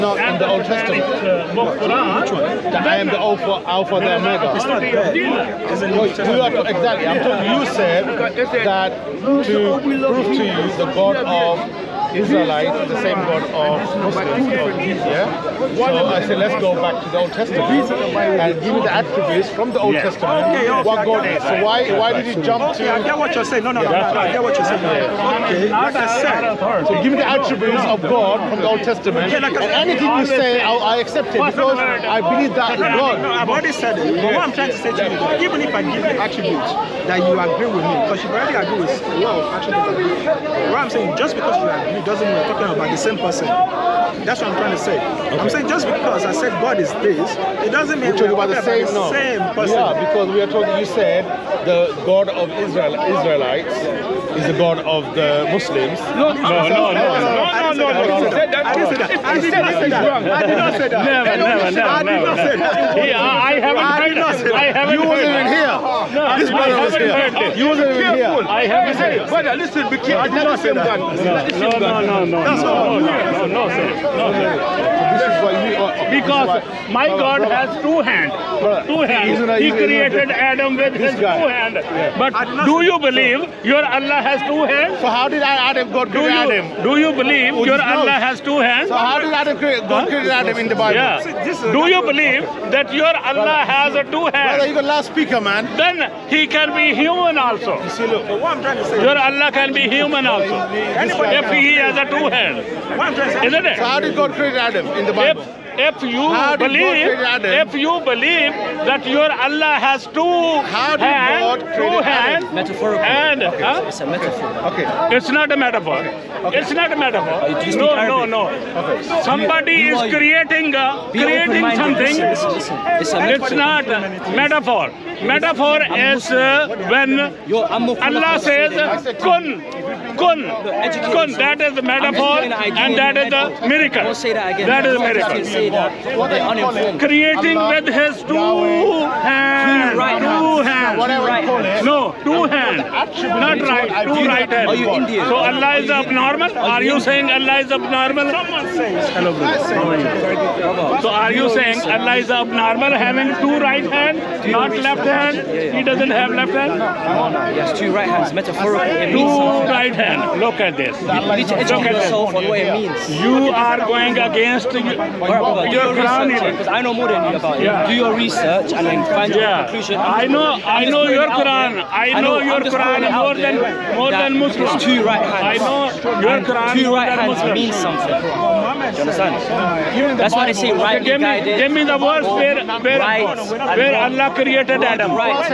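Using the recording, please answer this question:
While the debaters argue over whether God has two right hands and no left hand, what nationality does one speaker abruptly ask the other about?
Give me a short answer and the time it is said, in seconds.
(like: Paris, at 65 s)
Indian, at 144 s.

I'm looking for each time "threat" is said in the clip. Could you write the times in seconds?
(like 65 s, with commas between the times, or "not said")
not said.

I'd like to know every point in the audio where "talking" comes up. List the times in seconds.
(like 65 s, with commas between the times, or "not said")
7 s, 42 s, 50 s.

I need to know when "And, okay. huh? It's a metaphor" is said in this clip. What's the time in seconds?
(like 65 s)
113 s.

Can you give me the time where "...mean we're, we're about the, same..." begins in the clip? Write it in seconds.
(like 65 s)
47 s.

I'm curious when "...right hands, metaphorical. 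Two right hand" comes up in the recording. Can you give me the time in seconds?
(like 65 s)
157 s.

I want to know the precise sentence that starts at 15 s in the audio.
So I said, let's go back to the Old Testament and give me the attributes from the Old yeah.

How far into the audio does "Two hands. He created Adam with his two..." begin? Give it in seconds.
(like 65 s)
78 s.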